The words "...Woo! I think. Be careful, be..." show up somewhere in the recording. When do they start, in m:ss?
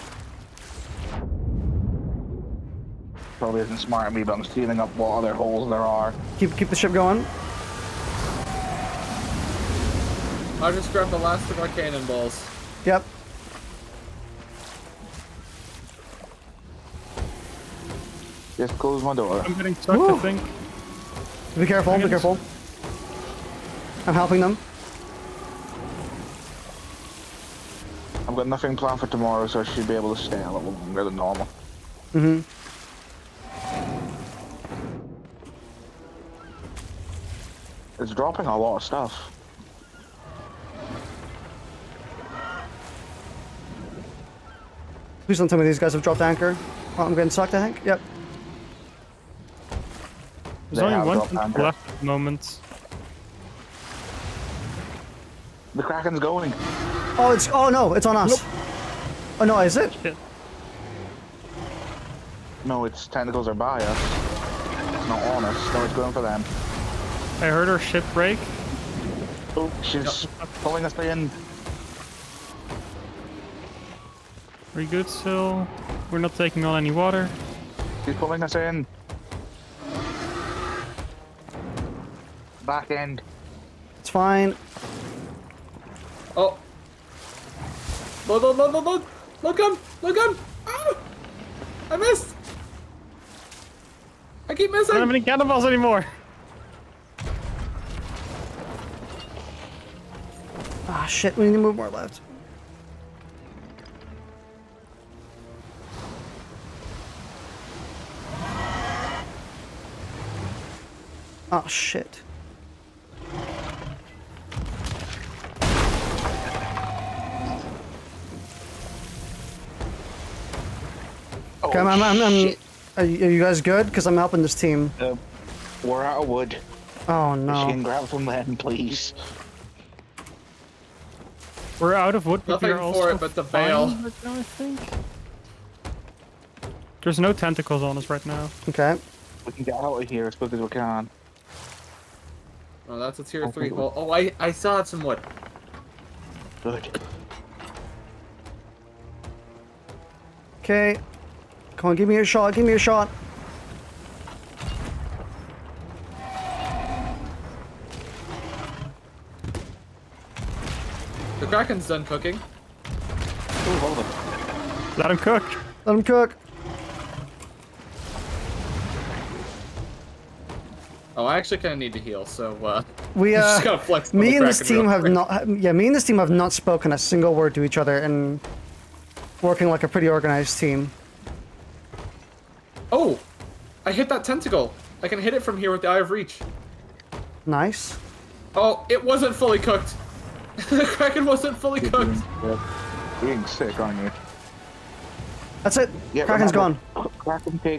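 0:19.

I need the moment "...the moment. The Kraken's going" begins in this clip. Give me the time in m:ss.
0:51.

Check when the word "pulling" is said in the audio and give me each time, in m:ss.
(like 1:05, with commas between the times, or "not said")
1:10, 1:18.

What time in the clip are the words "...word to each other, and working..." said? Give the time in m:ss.
2:57.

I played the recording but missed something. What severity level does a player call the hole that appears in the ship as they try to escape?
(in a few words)
tier three.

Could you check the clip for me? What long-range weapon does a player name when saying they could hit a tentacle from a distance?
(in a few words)
Eye of Reach.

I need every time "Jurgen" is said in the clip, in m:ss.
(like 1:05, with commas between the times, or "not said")
not said.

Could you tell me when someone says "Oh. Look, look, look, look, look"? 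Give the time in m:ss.
1:26.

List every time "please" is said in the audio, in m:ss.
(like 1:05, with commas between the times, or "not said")
0:45, 2:08.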